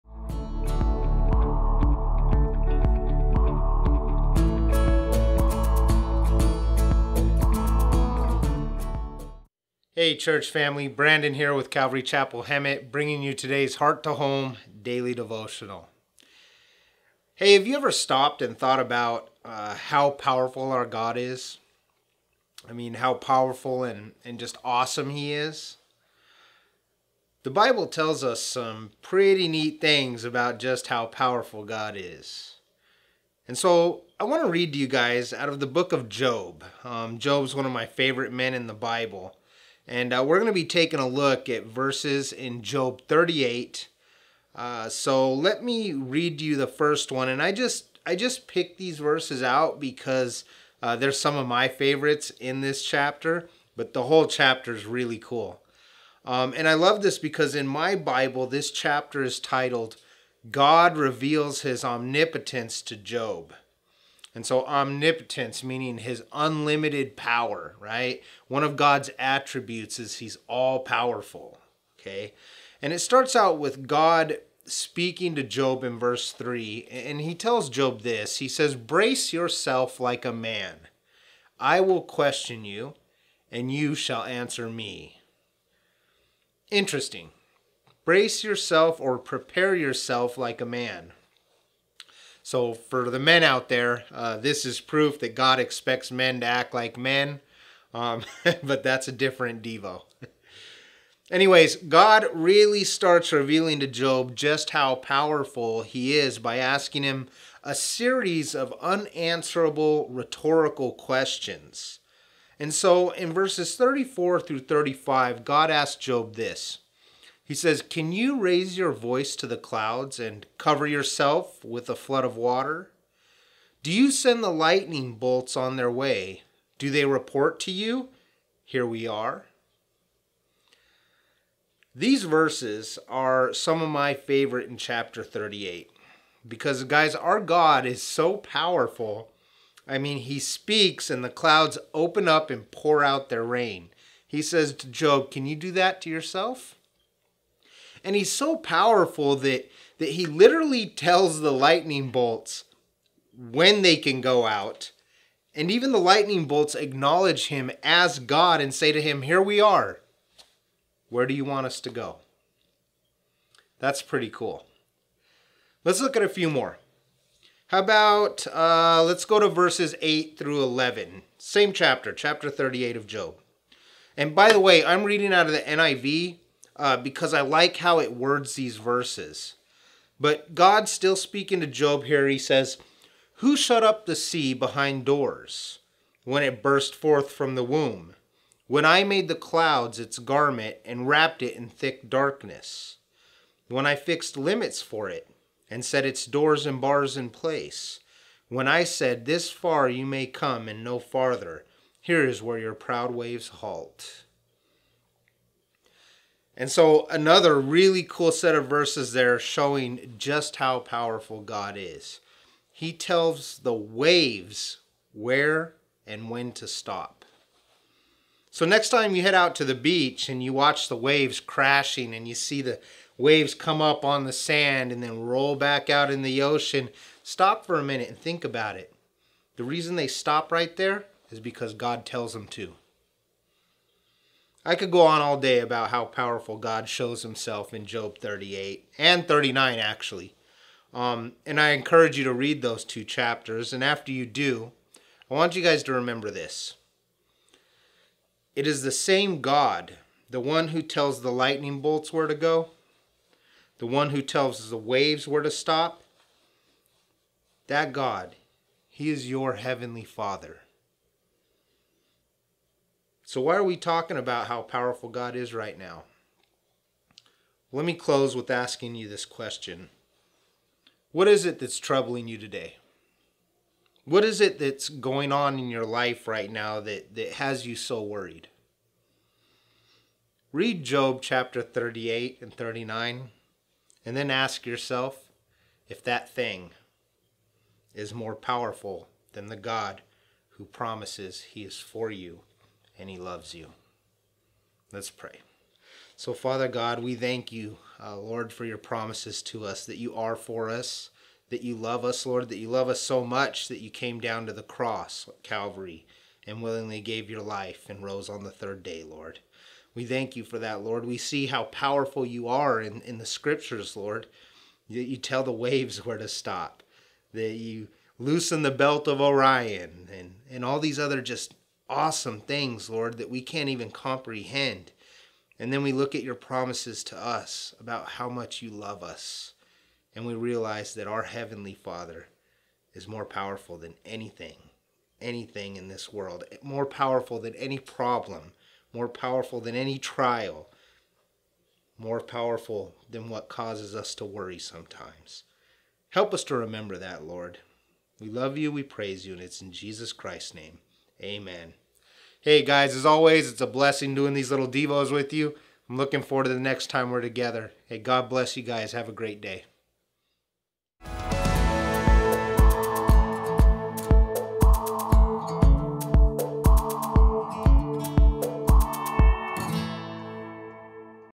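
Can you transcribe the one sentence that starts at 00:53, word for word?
But the whole chapter is really cool.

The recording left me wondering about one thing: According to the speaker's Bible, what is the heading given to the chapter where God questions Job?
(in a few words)
God Reveals His Omnipotence to Job.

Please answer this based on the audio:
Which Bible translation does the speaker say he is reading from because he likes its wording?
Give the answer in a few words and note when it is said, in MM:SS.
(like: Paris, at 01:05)
NIV, at 02:55.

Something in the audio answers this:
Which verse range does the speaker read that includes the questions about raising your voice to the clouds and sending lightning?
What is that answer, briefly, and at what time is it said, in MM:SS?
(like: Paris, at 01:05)
34 through 35, at 01:53.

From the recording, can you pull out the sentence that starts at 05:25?
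And then we look at your promises to us about how much you love us.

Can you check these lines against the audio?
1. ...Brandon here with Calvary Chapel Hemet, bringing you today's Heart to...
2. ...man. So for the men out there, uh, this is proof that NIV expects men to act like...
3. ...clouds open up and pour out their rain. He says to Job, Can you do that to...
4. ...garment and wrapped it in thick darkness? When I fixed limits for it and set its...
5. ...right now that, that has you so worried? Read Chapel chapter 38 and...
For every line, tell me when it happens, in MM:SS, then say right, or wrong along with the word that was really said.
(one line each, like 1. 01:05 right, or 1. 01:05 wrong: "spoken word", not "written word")
1. 00:10 right
2. 01:30 wrong: "God", not "NIV"
3. 02:21 right
4. 03:10 right
5. 04:36 wrong: "Job", not "Chapel".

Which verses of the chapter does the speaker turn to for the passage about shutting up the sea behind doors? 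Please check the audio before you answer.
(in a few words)
8 through 11.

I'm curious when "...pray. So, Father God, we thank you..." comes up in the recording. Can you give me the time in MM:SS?
04:55.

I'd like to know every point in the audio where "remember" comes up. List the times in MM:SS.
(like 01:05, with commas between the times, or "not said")
04:05, 05:46.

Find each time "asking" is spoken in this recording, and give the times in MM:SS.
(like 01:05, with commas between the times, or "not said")
01:46, 04:28.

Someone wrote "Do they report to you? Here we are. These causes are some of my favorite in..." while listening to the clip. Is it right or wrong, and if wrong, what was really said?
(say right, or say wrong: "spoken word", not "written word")
wrong: "verses", not "causes".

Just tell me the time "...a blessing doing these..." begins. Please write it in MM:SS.
05:53.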